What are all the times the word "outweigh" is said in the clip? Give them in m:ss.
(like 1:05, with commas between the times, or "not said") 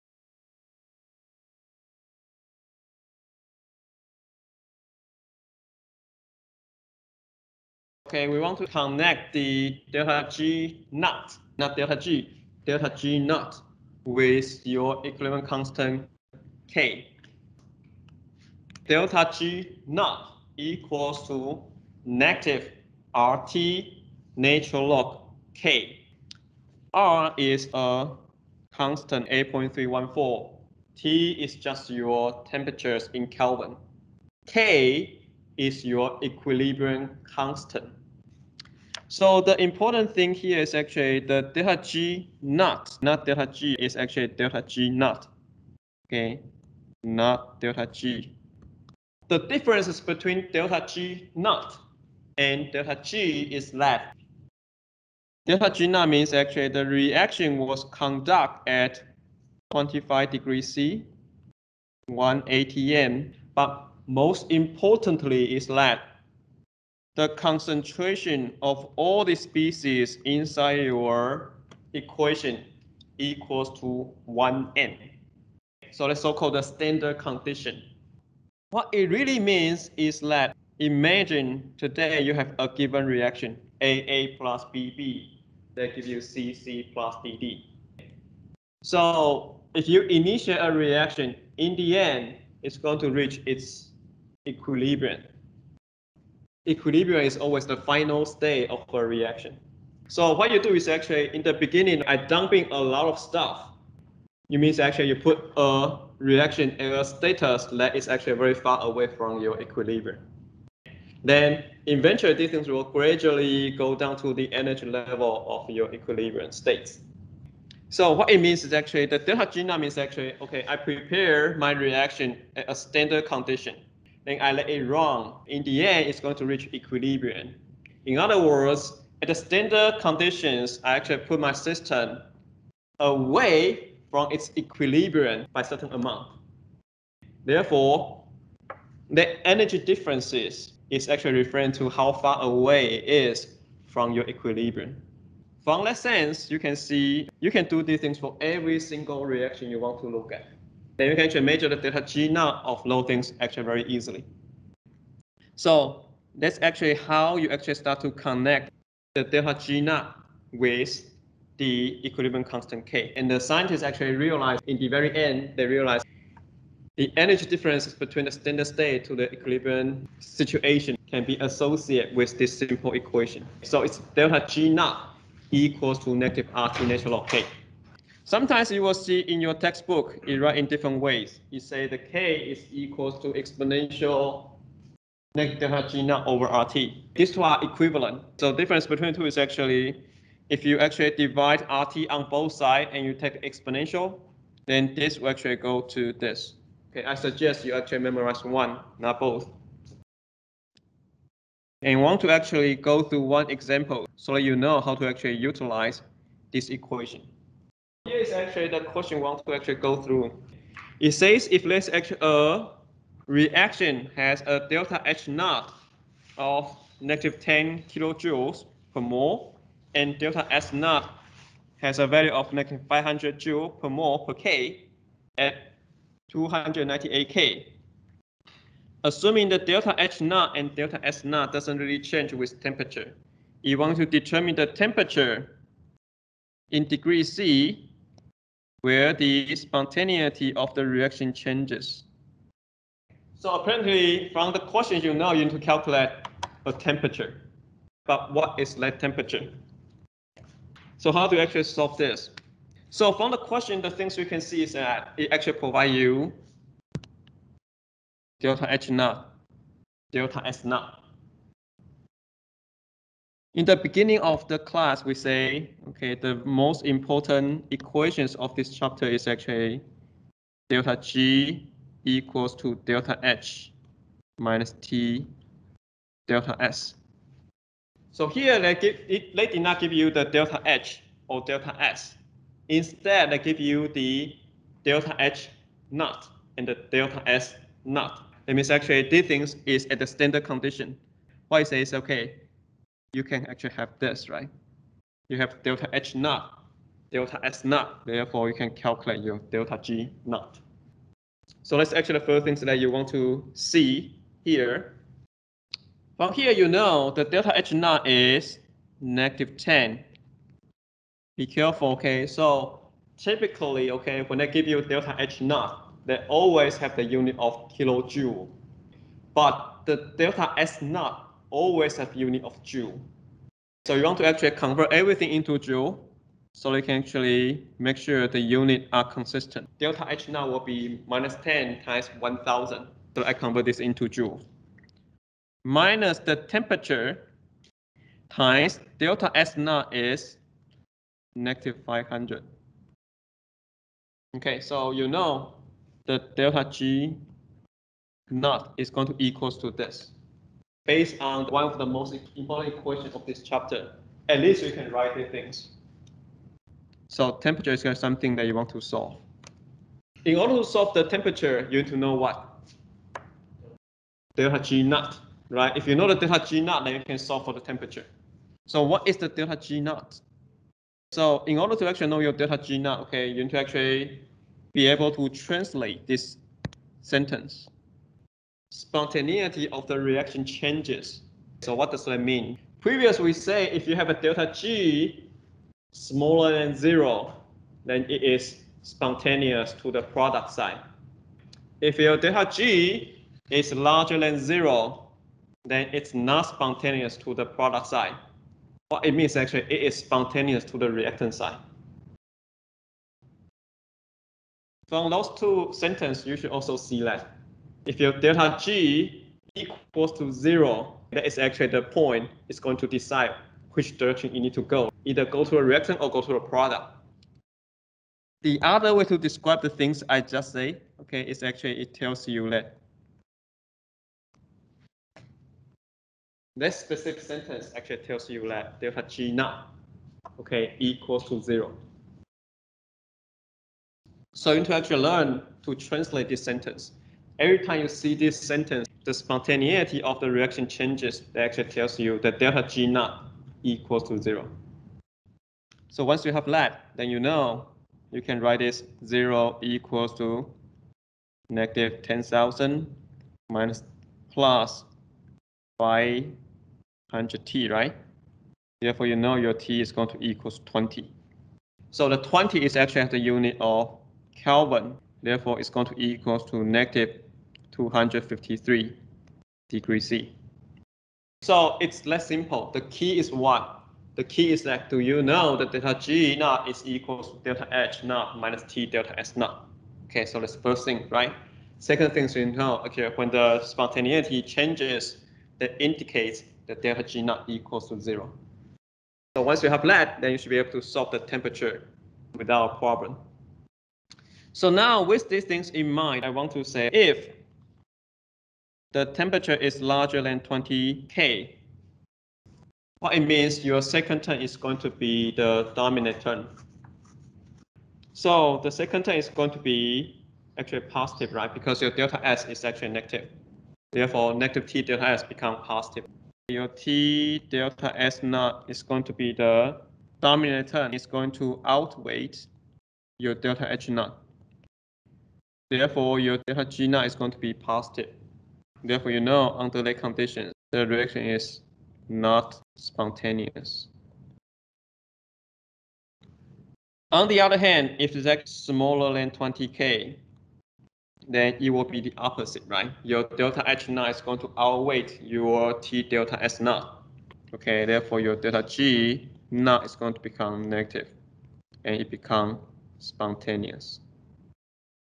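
8:41, 9:04.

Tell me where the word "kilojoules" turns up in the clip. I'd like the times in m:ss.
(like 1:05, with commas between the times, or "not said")
3:37, 5:17.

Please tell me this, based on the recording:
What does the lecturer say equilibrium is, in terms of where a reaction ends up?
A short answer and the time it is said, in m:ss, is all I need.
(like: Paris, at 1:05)
the final state, at 1:37.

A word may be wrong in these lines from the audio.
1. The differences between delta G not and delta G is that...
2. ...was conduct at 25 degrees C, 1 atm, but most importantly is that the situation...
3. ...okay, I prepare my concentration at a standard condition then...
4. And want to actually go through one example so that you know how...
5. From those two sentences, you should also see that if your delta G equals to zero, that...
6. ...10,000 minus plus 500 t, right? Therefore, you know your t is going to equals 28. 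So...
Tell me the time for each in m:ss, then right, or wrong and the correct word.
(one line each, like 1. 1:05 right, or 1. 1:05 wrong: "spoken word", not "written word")
1. 0:49 right
2. 0:57 wrong: "concentration", not "situation"
3. 2:00 wrong: "reaction", not "concentration"
4. 3:21 right
5. 6:44 right
6. 7:32 wrong: "20", not "28".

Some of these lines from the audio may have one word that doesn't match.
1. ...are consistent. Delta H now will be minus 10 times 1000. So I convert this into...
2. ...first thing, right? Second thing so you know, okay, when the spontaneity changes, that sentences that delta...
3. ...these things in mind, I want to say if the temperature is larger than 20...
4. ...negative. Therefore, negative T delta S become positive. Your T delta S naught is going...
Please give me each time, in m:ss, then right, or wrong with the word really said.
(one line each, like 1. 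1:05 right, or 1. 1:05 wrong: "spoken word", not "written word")
1. 5:28 right
2. 8:00 wrong: "indicates", not "sentences"
3. 8:15 right
4. 8:32 right.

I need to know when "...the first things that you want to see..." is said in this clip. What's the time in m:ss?
5:02.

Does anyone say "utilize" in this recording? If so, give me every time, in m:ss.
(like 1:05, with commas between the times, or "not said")
3:25.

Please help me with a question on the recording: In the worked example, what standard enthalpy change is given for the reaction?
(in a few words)
-10 kJ/mol.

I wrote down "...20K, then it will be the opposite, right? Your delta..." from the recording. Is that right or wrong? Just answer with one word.
right.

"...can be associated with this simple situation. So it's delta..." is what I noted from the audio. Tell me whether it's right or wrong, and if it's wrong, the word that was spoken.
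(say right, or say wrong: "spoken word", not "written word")
wrong: "equation", not "situation".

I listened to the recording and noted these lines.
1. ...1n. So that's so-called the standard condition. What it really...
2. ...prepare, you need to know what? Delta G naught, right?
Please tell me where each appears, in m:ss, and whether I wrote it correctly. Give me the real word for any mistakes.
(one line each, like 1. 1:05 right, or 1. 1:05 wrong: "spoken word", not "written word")
1. 1:14 right
2. 6:01 wrong: "temperature", not "prepare".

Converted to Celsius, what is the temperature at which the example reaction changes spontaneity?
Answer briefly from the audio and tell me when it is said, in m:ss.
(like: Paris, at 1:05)
-253 degrees C, at 7:46.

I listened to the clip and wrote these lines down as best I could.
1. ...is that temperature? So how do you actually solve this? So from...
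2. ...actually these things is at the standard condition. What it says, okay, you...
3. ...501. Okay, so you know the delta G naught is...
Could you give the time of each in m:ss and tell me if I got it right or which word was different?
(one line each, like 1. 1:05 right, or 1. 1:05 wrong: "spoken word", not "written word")
1. 4:08 right
2. 4:48 right
3. 5:41 wrong: "500", not "501".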